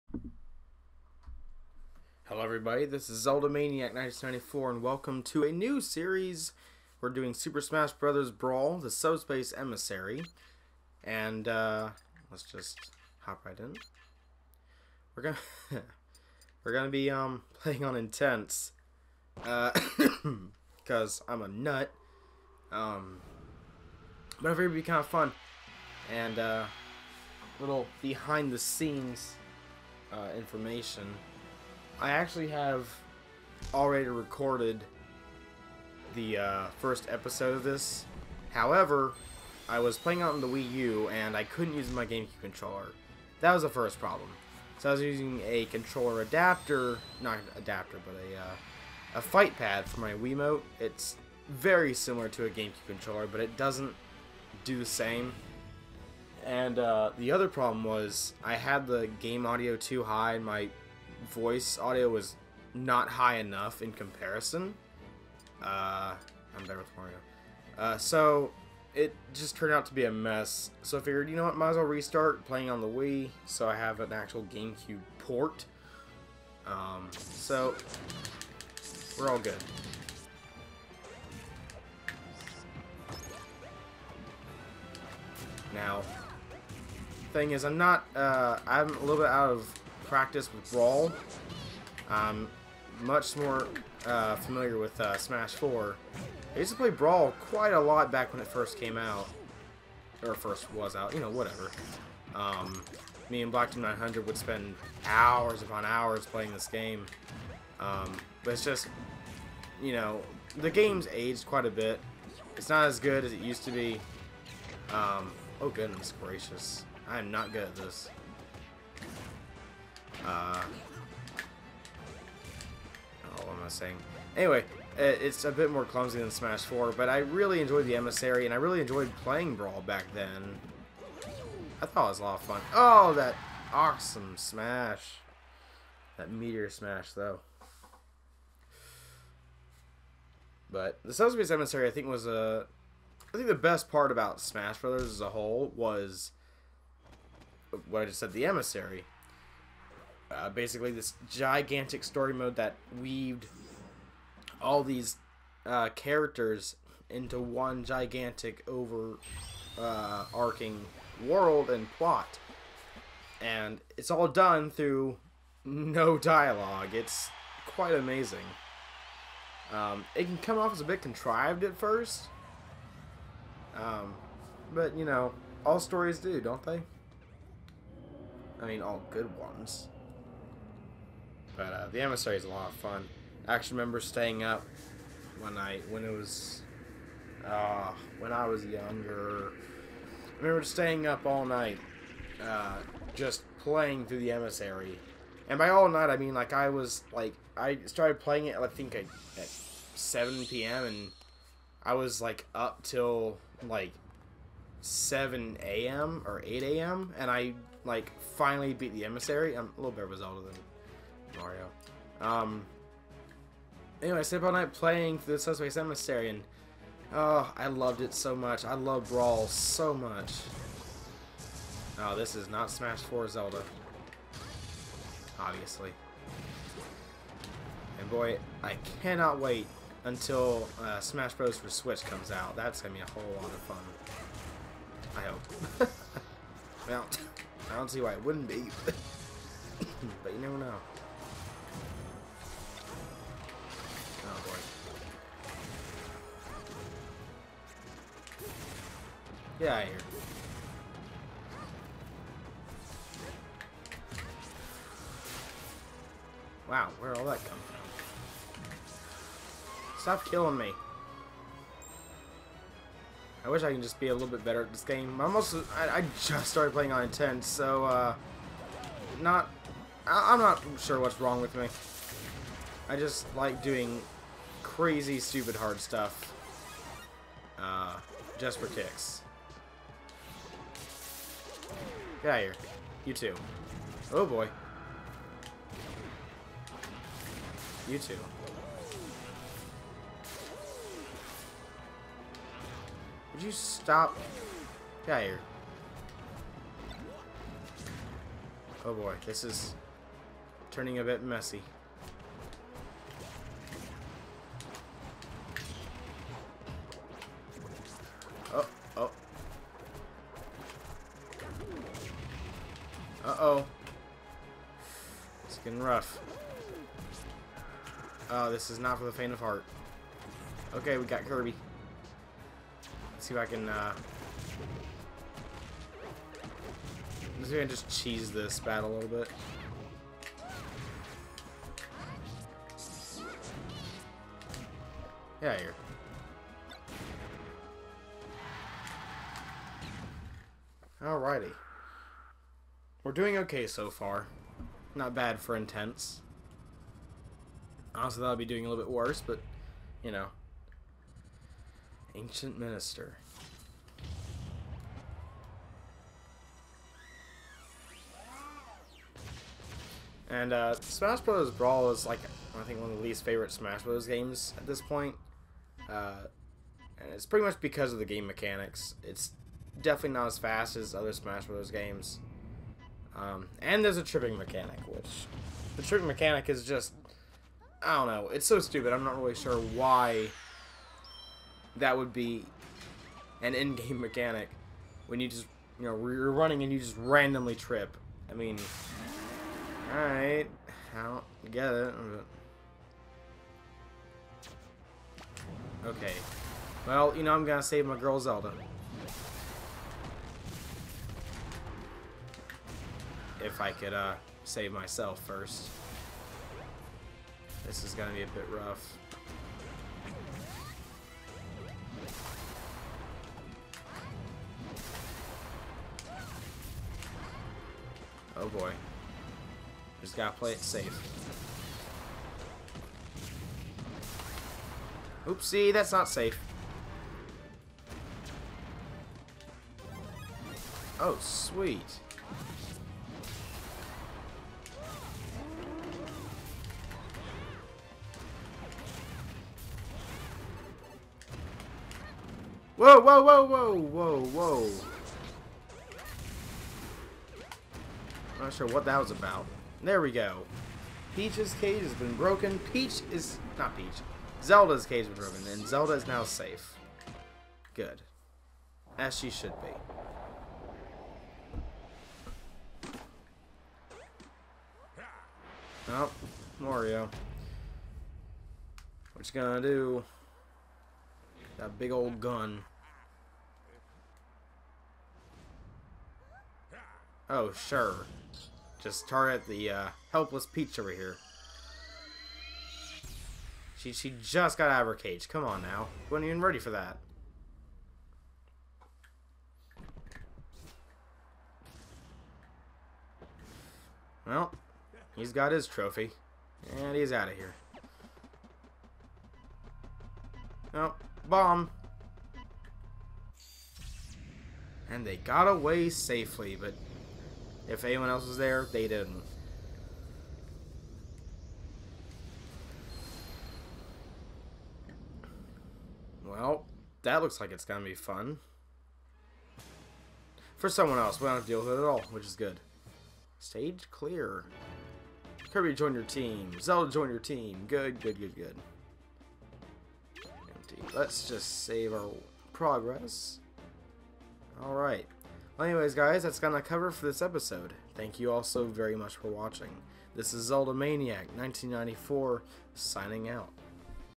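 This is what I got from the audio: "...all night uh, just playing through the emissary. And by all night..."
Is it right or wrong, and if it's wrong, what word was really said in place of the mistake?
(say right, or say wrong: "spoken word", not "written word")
right.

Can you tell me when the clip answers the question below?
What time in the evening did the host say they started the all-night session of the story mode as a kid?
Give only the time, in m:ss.
3:19.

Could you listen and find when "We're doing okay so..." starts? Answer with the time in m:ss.
5:43.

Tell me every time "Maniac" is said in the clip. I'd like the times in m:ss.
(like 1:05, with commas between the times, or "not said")
0:03, 9:00.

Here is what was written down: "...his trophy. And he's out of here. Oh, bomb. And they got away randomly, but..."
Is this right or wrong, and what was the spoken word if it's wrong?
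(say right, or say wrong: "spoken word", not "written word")
wrong: "safely", not "randomly".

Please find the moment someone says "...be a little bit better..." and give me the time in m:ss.
4:23.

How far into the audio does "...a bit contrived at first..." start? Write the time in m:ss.
2:50.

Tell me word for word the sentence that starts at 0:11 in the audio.
And uh, let's just hop right in.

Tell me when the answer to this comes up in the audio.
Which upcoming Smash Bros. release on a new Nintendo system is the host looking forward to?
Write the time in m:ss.
3:50.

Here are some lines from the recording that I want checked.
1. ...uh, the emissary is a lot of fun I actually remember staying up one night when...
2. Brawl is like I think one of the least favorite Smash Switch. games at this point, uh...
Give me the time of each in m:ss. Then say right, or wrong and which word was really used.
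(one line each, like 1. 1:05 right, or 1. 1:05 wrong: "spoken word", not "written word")
1. 3:01 right
2. 6:01 wrong: "Bros", not "Switch".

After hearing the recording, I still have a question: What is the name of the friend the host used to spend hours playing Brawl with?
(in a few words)
Black Team 900.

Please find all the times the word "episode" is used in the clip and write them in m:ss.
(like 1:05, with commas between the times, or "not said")
0:37, 8:57.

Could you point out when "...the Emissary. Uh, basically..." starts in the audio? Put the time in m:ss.
2:28.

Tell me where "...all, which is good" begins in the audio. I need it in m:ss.
8:41.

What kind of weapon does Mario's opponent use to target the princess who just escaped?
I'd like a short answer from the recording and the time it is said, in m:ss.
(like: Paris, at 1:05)
gun, at 7:52.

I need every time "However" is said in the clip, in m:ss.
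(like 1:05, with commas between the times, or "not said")
0:38.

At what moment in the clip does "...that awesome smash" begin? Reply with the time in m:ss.
2:13.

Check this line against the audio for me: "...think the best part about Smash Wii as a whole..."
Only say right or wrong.
wrong.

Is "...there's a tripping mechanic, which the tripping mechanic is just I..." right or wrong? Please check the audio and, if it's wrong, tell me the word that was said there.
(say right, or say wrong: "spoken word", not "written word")
right.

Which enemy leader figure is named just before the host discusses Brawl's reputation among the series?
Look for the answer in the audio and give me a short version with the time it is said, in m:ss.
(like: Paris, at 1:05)
Ancient Minister, at 5:52.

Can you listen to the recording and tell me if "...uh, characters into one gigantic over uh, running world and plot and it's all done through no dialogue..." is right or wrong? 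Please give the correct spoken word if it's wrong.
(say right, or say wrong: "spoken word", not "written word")
wrong: "arcing", not "running".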